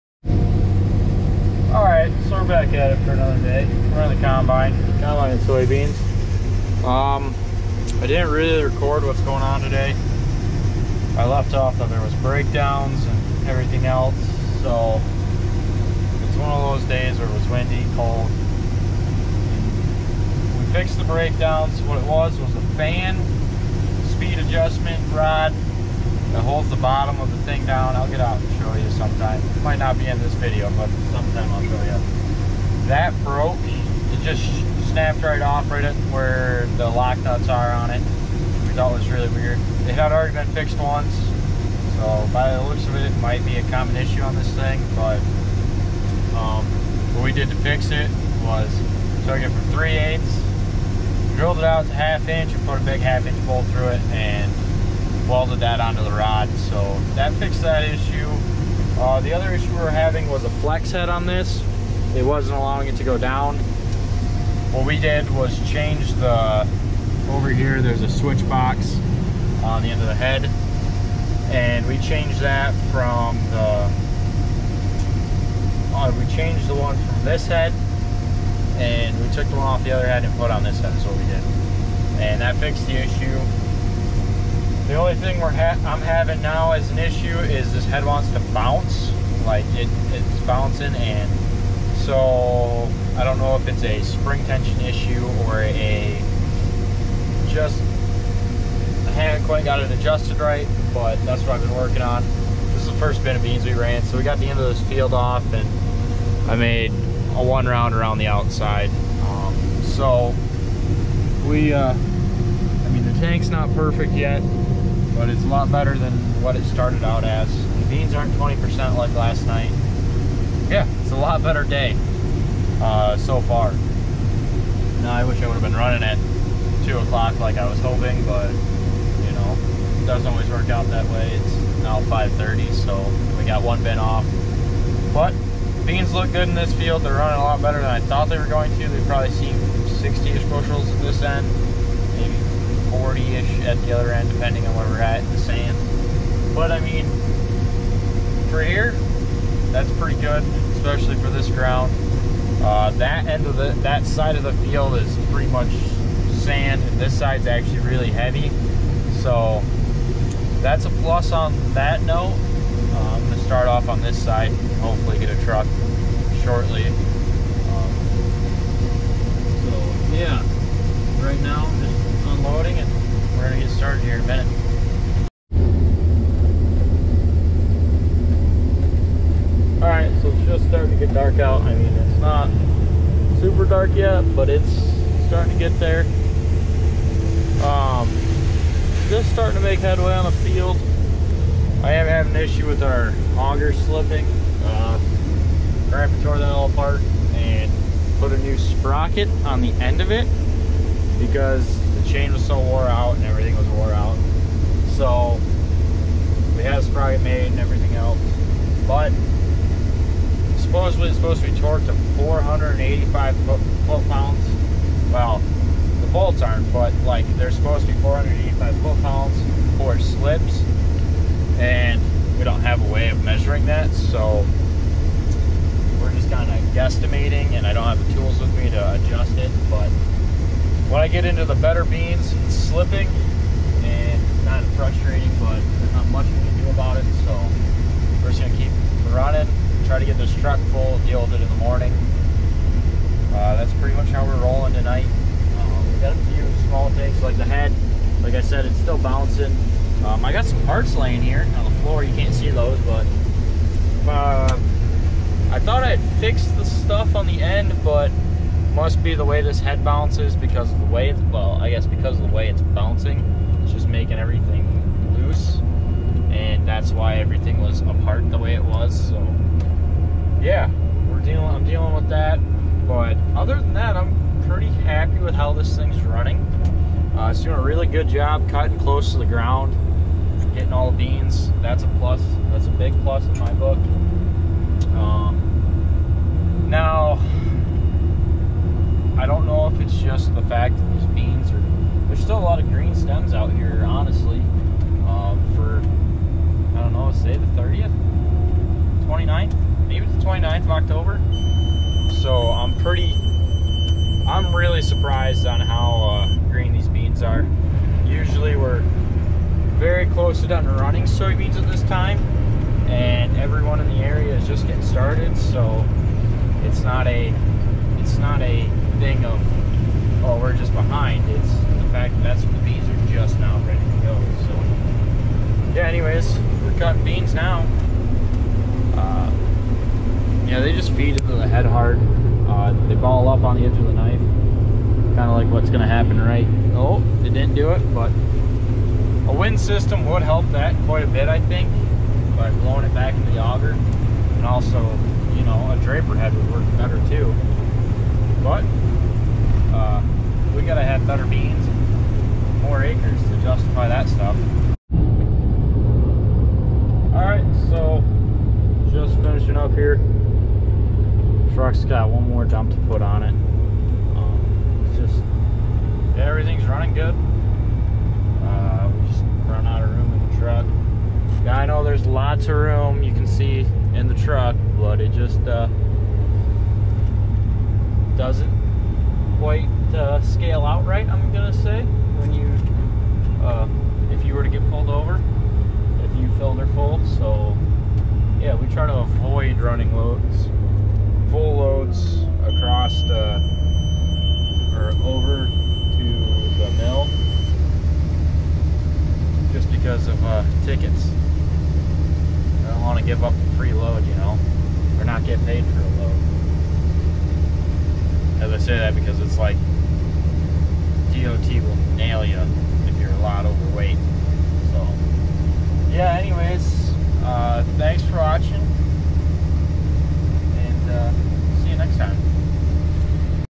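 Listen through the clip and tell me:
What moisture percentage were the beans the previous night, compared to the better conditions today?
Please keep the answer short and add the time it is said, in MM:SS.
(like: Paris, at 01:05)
20%, at 01:58.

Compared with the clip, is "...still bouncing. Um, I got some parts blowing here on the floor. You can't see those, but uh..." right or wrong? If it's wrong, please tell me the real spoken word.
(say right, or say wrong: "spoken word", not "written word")
wrong: "laying", not "blowing".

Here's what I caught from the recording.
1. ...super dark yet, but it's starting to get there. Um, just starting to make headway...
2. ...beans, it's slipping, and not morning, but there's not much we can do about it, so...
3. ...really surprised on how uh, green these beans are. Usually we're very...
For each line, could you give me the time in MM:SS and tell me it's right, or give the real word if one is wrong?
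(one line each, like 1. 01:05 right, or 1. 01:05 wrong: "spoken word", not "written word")
1. 03:03 right
2. 03:51 wrong: "frustrating", not "morning"
3. 05:04 right.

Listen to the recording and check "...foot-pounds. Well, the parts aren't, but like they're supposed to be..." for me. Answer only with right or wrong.
wrong.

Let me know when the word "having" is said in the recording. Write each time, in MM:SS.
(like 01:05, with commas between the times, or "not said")
00:59, 01:26.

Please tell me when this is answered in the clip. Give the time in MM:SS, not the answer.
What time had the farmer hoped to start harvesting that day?
02:06.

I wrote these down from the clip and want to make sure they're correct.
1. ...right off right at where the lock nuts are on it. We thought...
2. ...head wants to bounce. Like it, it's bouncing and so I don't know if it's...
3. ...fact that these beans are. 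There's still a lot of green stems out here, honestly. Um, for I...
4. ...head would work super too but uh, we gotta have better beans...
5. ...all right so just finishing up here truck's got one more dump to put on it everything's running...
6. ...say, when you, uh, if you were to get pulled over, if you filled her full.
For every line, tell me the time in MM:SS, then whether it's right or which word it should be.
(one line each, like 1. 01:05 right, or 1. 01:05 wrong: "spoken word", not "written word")
1. 00:35 right
2. 01:27 right
3. 04:50 right
4. 05:46 wrong: "better", not "super"
5. 05:57 right
6. 06:21 right.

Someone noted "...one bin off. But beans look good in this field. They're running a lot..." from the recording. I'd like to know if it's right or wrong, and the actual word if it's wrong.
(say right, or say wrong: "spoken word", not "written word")
right.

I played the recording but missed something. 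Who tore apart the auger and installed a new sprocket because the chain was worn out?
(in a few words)
Grandpa.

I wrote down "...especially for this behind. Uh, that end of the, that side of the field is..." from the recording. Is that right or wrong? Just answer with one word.
wrong.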